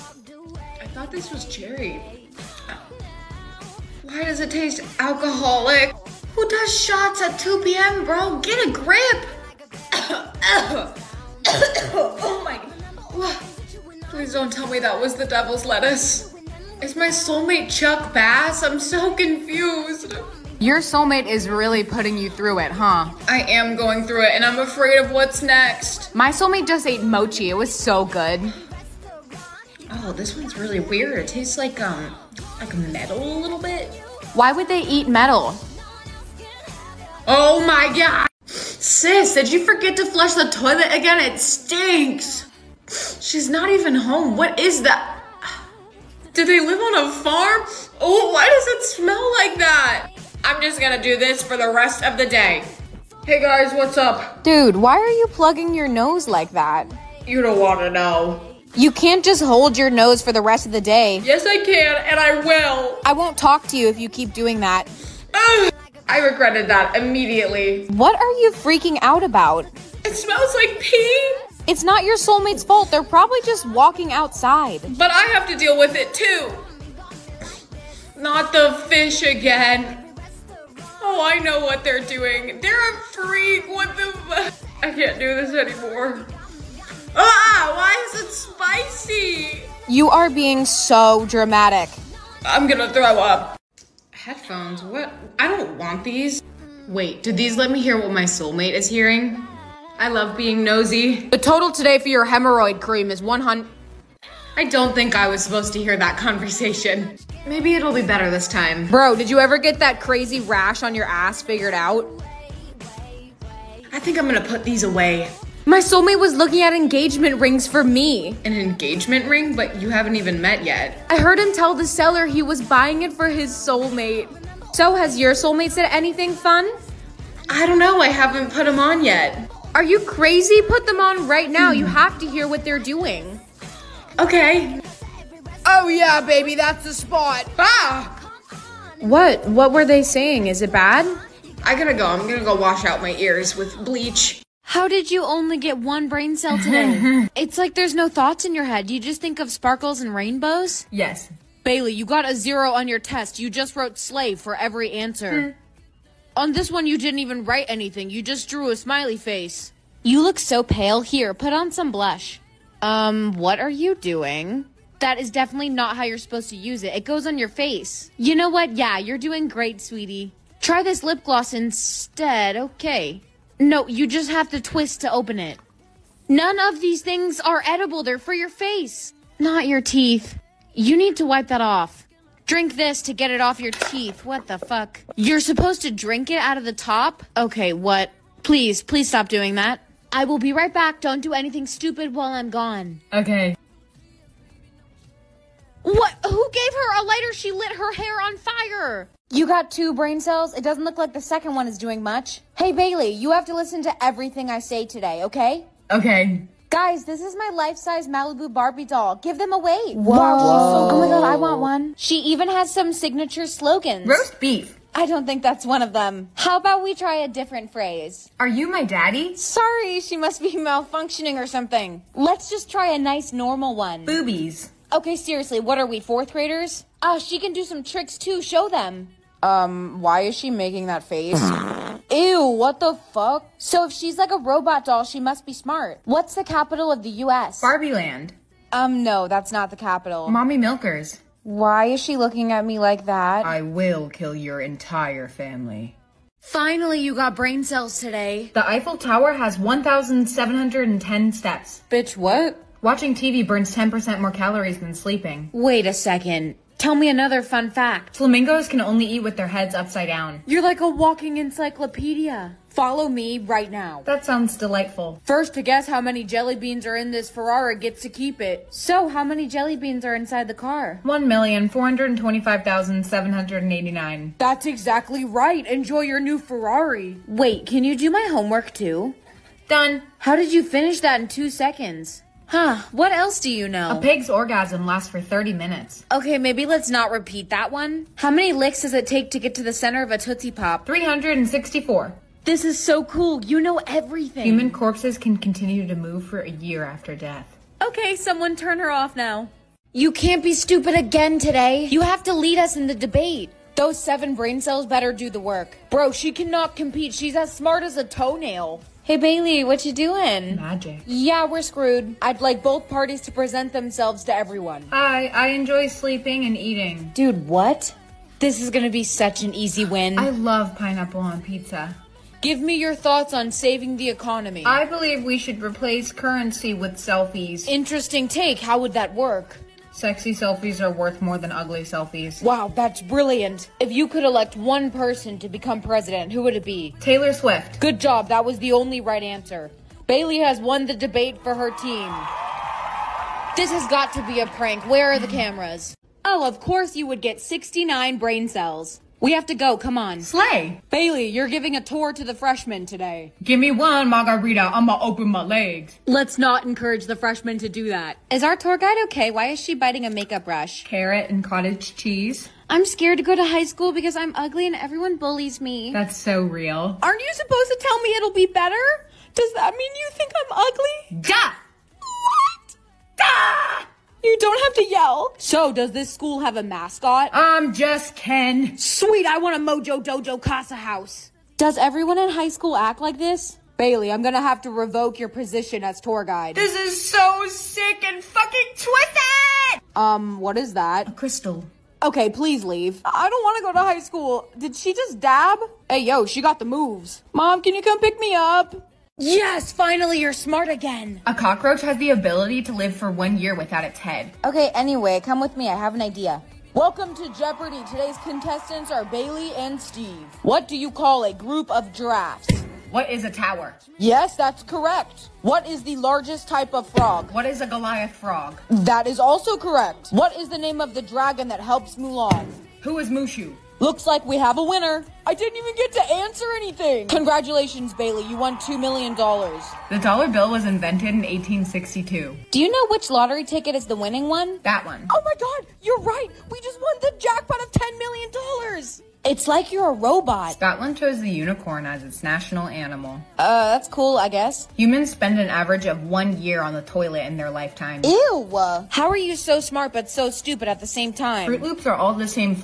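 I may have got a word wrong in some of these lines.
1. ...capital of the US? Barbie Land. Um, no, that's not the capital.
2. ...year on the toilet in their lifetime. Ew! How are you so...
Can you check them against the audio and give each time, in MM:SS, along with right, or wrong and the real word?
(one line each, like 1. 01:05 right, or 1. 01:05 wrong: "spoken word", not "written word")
1. 03:56 right
2. 07:26 right.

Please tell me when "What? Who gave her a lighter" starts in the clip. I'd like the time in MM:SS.
03:15.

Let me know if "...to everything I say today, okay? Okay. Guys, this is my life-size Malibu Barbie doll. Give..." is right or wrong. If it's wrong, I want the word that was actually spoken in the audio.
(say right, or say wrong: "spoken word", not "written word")
right.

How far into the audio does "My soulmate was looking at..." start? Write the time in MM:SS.
01:55.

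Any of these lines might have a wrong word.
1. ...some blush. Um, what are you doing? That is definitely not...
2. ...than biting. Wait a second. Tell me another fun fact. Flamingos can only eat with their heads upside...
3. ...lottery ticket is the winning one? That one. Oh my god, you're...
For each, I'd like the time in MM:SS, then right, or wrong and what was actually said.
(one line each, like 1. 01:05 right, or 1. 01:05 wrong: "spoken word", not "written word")
1. 02:41 right
2. 04:14 wrong: "sleeping", not "biting"
3. 07:13 right.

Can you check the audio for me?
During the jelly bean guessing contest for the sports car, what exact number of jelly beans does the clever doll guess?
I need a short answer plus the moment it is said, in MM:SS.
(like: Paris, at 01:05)
1,425,789, at 04:31.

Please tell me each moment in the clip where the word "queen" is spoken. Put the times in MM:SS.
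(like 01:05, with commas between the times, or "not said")
not said.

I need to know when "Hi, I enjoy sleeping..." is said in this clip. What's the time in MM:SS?
05:14.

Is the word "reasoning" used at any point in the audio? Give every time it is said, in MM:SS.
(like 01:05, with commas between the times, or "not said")
not said.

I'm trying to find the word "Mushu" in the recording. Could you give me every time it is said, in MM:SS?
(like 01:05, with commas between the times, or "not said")
07:03.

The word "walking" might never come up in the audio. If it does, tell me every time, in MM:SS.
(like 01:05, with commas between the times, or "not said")
01:13, 04:20.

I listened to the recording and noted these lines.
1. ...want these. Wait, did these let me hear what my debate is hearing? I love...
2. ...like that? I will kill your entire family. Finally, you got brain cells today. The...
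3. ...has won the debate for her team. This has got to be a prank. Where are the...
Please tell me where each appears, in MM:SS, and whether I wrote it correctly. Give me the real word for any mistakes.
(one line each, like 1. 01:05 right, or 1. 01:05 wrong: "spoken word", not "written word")
1. 01:35 wrong: "soulmate", not "debate"
2. 04:02 right
3. 05:40 right.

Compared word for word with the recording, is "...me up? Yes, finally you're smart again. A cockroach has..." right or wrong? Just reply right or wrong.
right.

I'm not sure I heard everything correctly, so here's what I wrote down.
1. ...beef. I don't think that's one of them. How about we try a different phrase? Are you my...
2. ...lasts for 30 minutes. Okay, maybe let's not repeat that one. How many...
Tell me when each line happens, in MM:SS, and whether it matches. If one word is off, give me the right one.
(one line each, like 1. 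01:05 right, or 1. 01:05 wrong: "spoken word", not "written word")
1. 03:34 right
2. 04:44 right.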